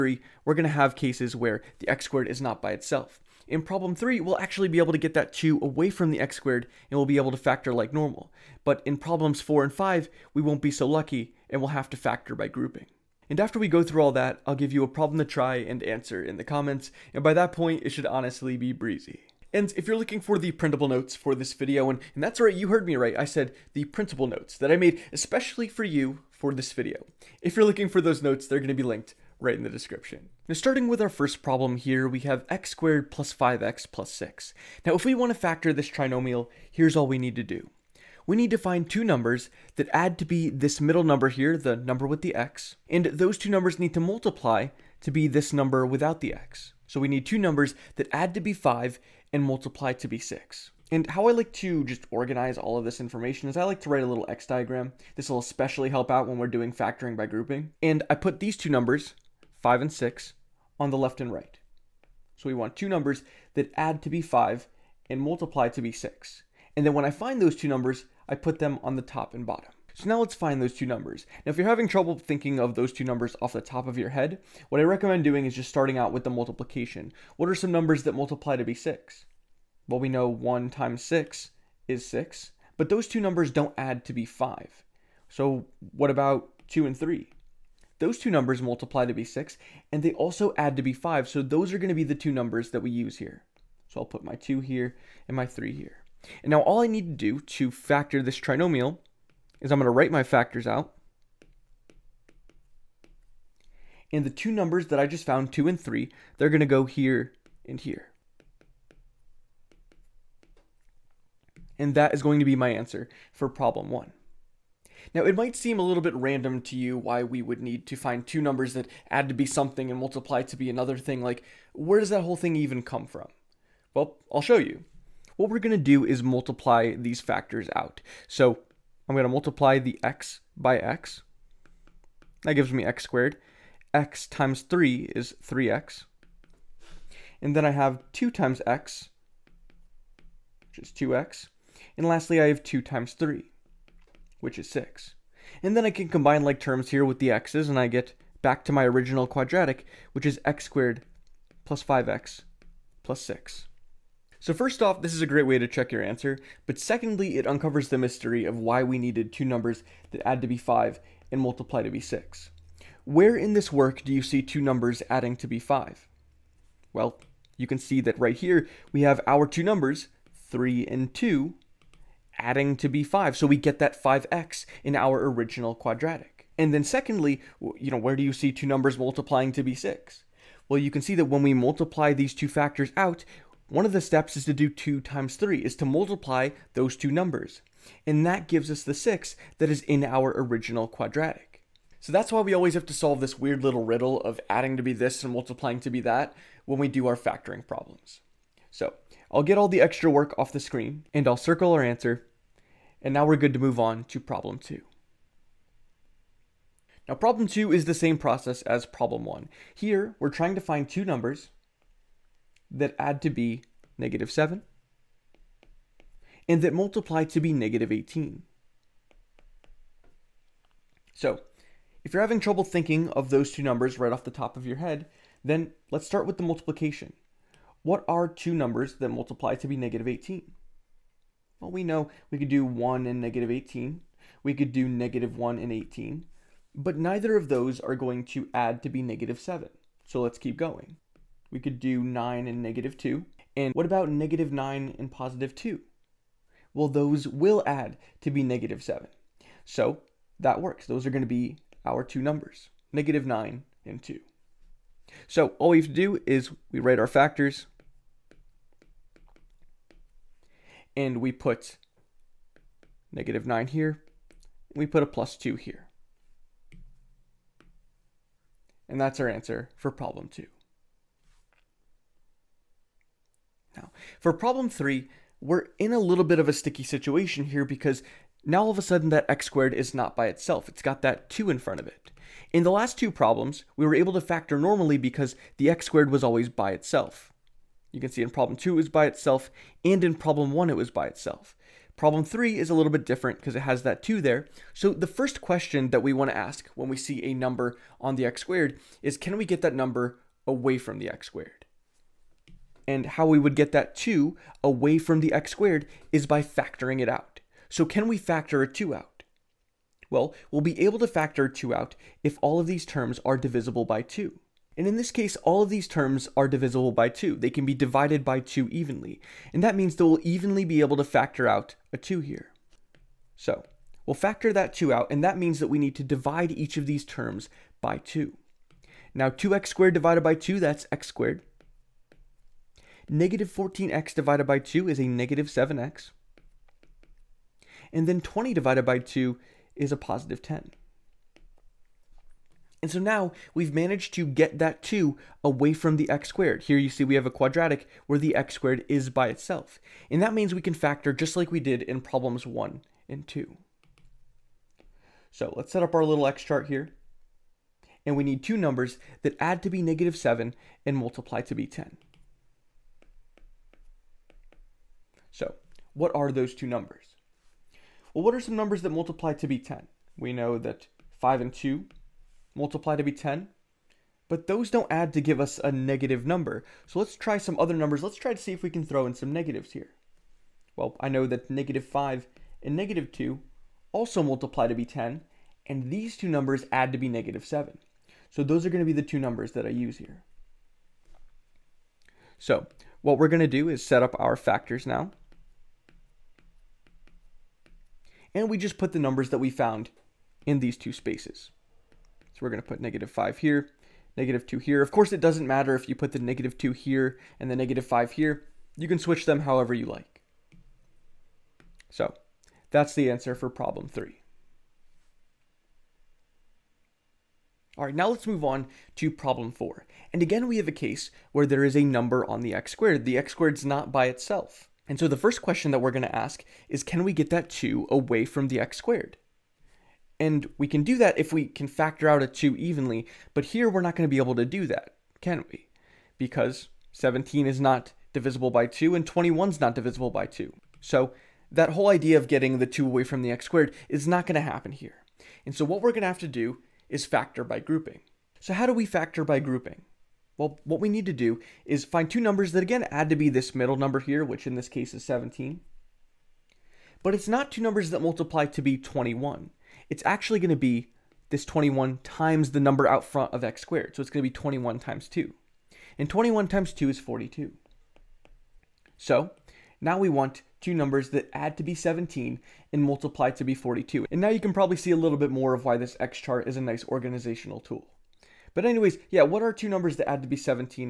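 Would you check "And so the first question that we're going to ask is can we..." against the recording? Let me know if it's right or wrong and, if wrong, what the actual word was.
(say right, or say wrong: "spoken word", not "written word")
right.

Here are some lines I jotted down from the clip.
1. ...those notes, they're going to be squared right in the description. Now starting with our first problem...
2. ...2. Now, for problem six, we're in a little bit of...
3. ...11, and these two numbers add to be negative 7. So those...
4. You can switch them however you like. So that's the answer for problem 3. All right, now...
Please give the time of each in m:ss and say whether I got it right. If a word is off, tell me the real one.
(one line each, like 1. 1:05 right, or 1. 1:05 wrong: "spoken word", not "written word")
1. 0:28 wrong: "linked", not "squared"
2. 4:30 wrong: "three", not "six"
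3. 6:24 wrong: "10", not "11"
4. 6:48 right.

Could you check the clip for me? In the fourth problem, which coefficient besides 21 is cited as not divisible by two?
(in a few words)
17.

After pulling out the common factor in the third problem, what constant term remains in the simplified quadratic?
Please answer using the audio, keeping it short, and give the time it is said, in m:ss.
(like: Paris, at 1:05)
10, at 5:39.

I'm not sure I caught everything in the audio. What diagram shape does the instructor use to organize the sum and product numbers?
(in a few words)
x diagram.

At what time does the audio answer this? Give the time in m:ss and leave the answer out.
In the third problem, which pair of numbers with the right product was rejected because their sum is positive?
6:11.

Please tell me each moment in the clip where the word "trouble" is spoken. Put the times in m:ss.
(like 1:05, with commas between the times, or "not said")
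1:11, 3:42.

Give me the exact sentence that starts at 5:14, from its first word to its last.
And in this case, all of these terms are divisible by 2.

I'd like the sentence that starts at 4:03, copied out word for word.
And what about negative 9 and positive 2?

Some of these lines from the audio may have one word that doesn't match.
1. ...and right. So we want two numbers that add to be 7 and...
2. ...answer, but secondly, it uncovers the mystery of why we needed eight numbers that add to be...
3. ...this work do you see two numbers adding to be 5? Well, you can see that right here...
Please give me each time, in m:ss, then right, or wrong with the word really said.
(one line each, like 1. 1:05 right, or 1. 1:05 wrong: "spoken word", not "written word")
1. 1:01 wrong: "5", not "7"
2. 2:36 wrong: "two", not "eight"
3. 2:43 right.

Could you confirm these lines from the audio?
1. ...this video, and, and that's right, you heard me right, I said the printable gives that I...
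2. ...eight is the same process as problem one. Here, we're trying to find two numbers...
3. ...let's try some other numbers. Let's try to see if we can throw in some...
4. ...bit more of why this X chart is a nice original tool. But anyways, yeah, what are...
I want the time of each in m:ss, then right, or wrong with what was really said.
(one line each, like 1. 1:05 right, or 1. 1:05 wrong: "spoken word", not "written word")
1. 0:21 wrong: "notes", not "gives"
2. 3:27 wrong: "two", not "eight"
3. 6:16 right
4. 7:55 wrong: "organizational", not "original".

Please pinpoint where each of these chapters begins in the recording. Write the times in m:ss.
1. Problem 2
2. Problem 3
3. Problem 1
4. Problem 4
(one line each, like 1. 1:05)
1. 3:25
2. 4:31
3. 0:29
4. 6:55.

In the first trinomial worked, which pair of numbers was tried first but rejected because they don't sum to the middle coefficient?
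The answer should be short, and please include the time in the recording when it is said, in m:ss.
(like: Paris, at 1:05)
1 and 6, at 1:20.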